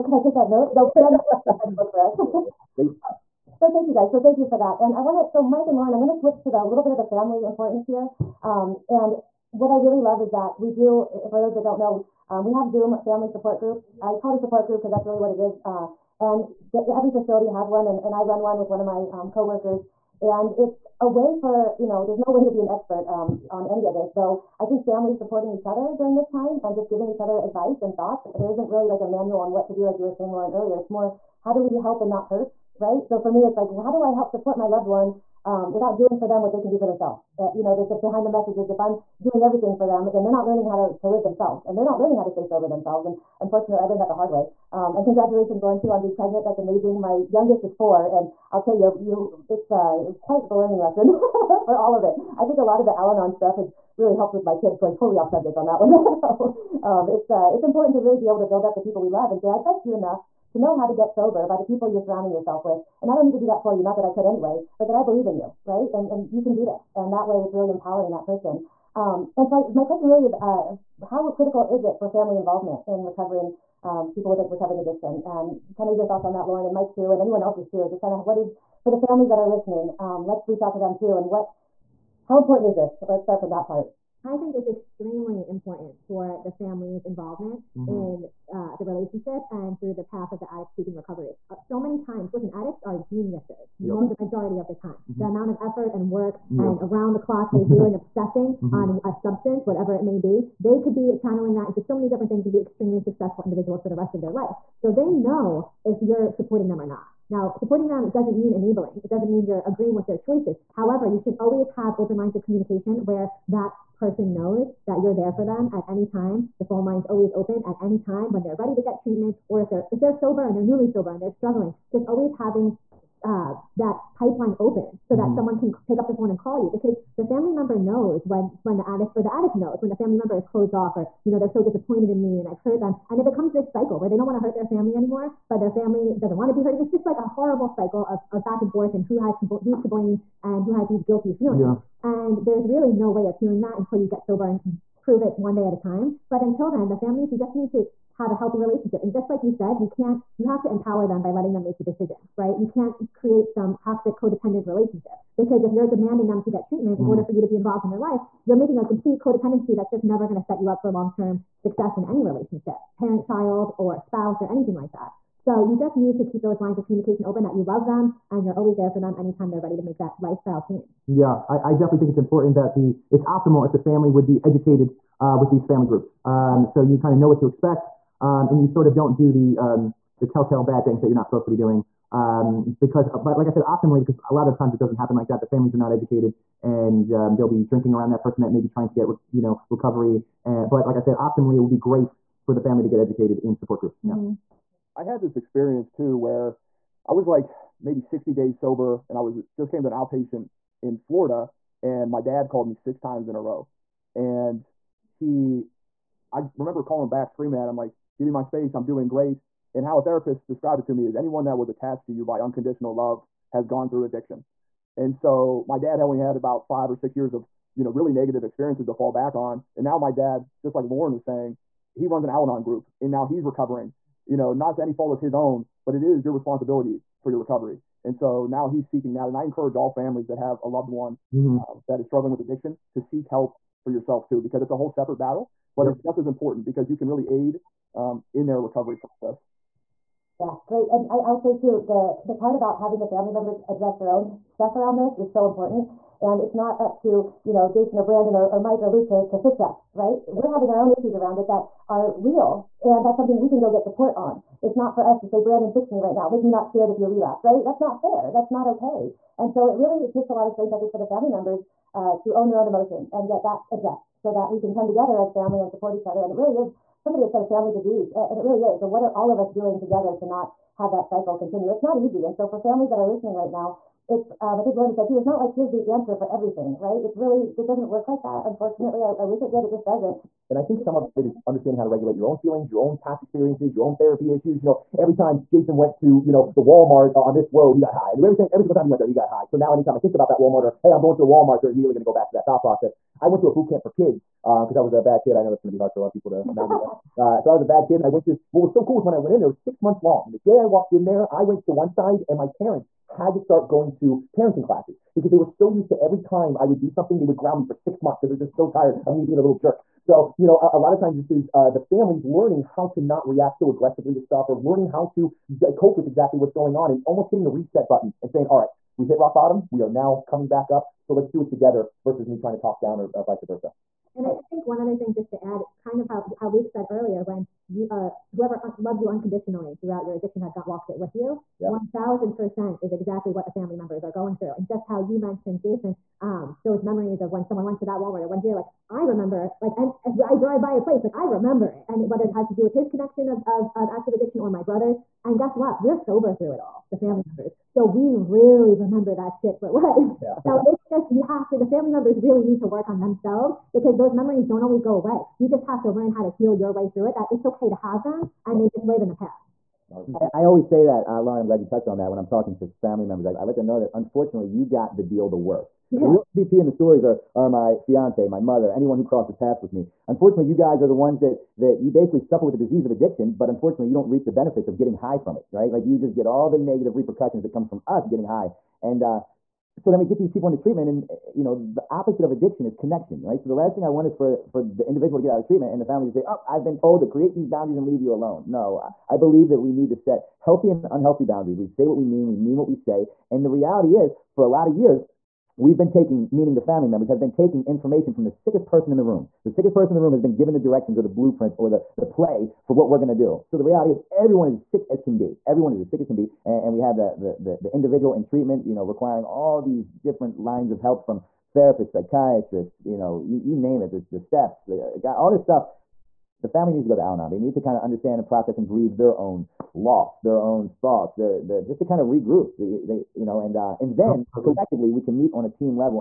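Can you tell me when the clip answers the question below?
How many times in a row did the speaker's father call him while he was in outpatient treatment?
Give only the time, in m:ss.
3:22.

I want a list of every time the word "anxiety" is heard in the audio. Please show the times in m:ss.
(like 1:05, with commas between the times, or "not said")
not said.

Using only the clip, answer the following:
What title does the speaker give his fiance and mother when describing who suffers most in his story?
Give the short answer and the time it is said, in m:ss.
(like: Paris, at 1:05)
the real MVP, at 6:06.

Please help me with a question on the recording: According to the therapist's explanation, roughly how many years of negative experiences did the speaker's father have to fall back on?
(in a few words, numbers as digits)
5 or 6 years.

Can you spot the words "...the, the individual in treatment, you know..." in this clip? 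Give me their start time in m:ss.
6:47.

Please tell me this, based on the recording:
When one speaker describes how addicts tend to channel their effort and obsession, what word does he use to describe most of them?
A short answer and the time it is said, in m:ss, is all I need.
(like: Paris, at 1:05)
geniuses, at 1:32.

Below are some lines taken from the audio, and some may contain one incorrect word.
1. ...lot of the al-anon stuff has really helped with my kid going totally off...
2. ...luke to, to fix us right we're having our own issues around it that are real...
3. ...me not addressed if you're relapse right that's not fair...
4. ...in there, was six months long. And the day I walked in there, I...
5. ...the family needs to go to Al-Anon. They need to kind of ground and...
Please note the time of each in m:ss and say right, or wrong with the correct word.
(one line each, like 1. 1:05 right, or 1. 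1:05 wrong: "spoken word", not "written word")
1. 0:52 right
2. 4:08 right
3. 4:16 wrong: "scared", not "addressed"
4. 4:59 right
5. 6:56 wrong: "understand", not "ground".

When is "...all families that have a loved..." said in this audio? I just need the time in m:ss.
3:49.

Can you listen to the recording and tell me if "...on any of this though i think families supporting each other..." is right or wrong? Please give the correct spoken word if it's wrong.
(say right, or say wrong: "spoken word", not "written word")
right.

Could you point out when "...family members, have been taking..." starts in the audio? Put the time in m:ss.
6:36.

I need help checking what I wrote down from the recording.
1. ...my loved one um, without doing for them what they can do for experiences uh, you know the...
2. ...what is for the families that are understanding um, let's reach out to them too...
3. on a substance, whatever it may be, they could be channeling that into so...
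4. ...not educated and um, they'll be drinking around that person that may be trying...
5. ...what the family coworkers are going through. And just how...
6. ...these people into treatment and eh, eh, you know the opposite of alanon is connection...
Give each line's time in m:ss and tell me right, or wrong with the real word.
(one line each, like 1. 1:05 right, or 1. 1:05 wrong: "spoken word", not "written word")
1. 0:34 wrong: "themselves", not "experiences"
2. 1:18 wrong: "listening", not "understanding"
3. 1:38 right
4. 3:05 right
5. 5:33 wrong: "members", not "coworkers"
6. 6:20 wrong: "addiction", not "alanon".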